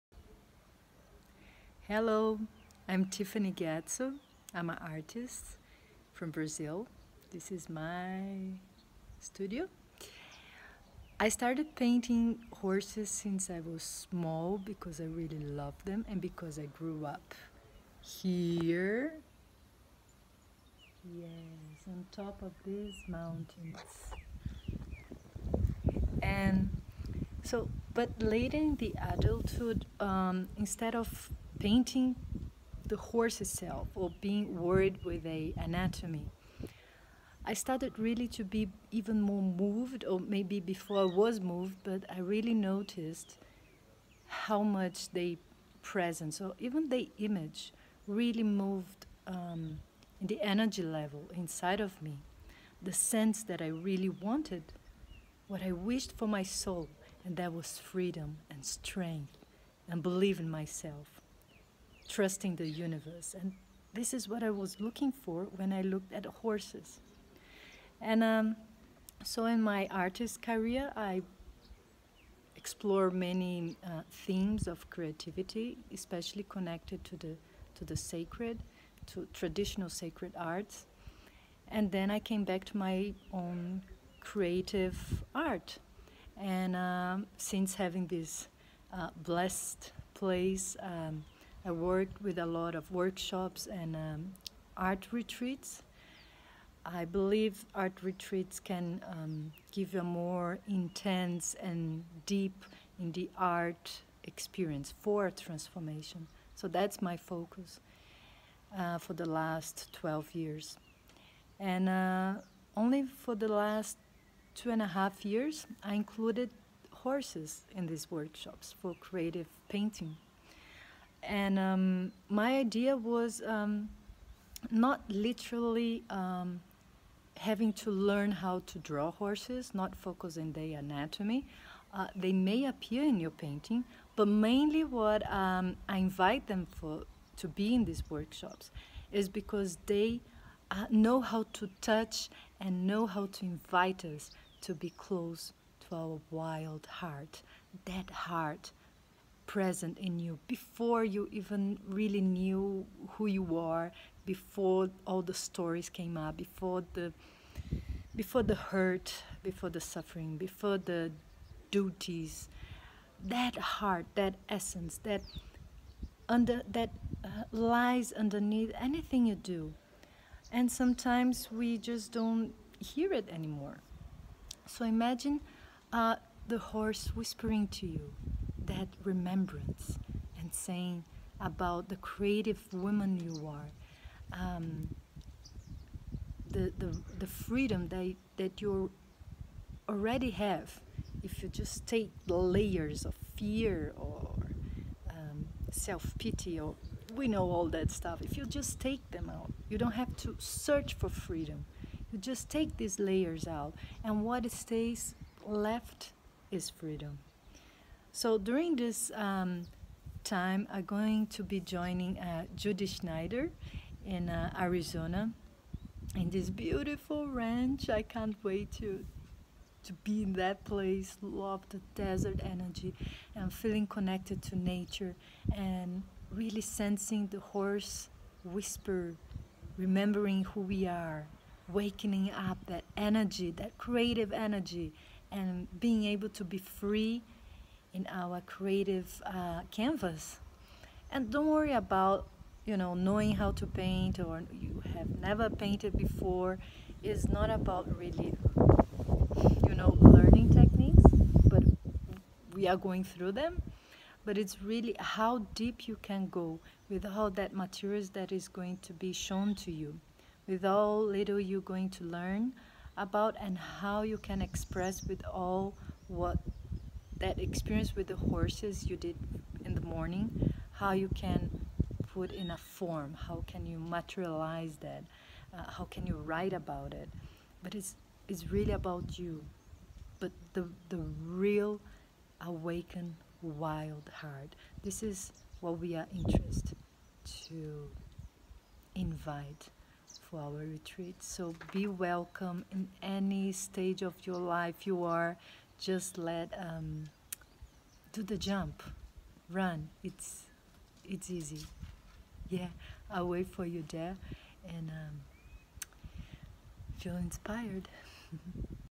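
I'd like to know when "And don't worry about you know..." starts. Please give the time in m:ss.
4:01.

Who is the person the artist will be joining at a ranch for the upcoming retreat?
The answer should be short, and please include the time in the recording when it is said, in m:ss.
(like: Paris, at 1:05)
Judy Schneider, at 3:32.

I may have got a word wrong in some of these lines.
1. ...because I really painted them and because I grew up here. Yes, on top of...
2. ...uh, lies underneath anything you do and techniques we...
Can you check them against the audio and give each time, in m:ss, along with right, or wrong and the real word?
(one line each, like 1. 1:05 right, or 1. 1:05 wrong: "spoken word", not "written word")
1. 0:14 wrong: "loved", not "painted"
2. 2:47 wrong: "sometimes", not "techniques".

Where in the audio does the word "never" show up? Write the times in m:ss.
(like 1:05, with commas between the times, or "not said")
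4:05.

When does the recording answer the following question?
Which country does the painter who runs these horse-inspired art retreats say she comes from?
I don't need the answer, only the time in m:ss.
0:06.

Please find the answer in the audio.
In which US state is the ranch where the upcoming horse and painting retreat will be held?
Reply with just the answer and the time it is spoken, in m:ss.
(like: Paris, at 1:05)
Arizona, at 3:34.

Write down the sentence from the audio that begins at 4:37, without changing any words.
But it's, it's really about you.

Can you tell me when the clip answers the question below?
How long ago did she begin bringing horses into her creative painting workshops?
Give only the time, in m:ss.
1:54.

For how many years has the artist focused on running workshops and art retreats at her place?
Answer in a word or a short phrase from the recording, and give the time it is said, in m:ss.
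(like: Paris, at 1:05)
12, at 1:49.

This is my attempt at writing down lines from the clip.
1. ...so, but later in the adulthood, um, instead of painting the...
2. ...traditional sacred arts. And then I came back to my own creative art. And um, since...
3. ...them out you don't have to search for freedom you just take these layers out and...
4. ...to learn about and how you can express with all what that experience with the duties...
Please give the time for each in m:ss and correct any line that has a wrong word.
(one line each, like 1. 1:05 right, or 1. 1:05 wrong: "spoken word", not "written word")
1. 0:27 right
2. 1:19 right
3. 3:19 right
4. 4:21 wrong: "horses", not "duties".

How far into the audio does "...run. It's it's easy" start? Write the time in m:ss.
4:59.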